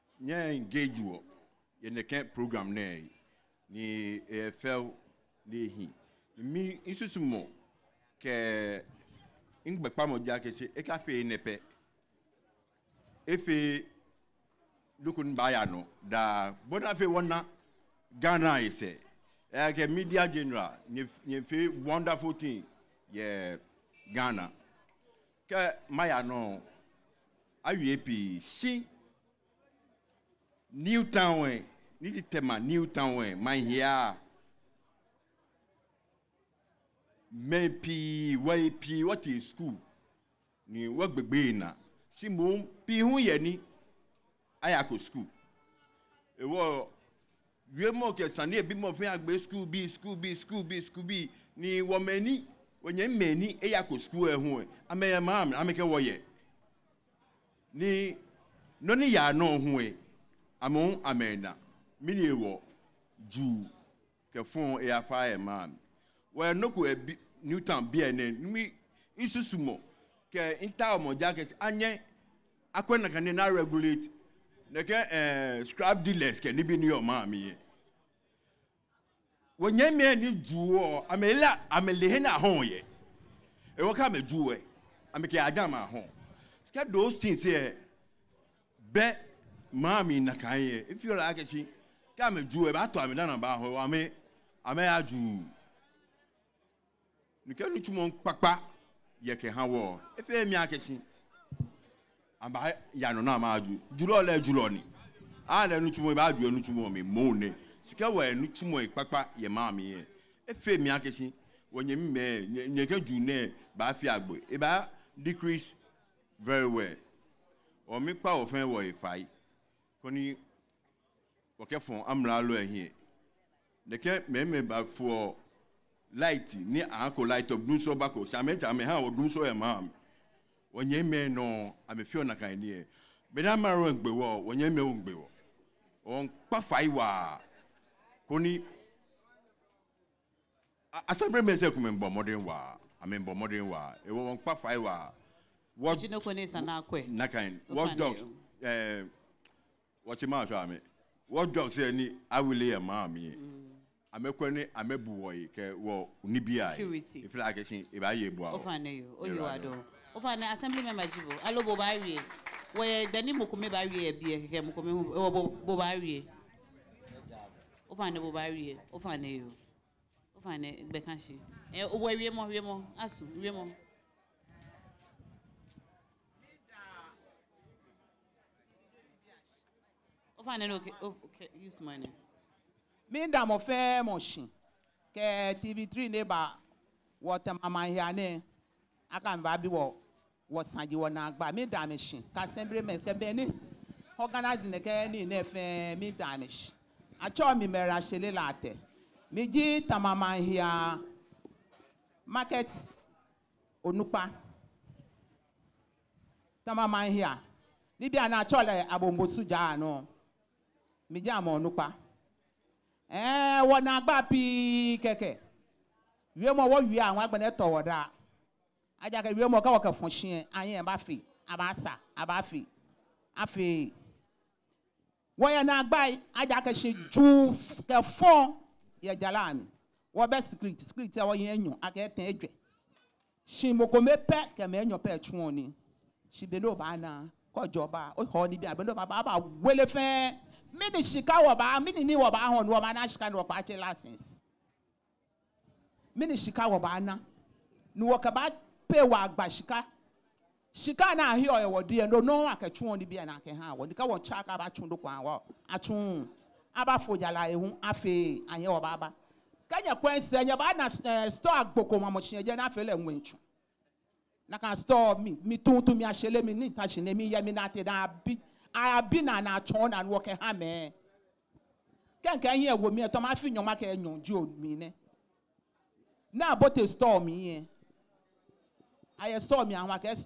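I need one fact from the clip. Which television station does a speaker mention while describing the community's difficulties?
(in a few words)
TV3.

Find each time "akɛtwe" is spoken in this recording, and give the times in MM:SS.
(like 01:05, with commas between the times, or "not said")
04:12.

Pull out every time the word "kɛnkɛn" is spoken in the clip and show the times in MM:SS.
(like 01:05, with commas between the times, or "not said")
04:32.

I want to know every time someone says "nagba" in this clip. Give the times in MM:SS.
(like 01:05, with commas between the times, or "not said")
03:11, 03:33.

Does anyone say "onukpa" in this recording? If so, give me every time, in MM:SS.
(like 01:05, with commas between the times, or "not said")
03:23, 03:31.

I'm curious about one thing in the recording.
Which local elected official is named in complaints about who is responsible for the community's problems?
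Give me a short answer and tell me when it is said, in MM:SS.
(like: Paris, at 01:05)
assembly member, at 02:40.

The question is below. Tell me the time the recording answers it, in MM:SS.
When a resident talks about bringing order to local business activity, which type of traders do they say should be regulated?
01:15.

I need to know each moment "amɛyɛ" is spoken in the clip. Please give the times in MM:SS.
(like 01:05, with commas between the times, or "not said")
00:54.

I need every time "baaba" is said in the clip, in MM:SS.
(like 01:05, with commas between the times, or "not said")
04:18.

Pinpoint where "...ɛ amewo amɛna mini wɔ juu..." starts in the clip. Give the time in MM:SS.
00:59.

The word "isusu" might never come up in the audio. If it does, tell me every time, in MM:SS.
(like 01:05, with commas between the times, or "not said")
00:06, 01:09.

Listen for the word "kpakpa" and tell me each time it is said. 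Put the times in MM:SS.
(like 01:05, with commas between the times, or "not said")
01:38, 01:48.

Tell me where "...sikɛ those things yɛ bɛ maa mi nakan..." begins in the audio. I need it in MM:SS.
01:26.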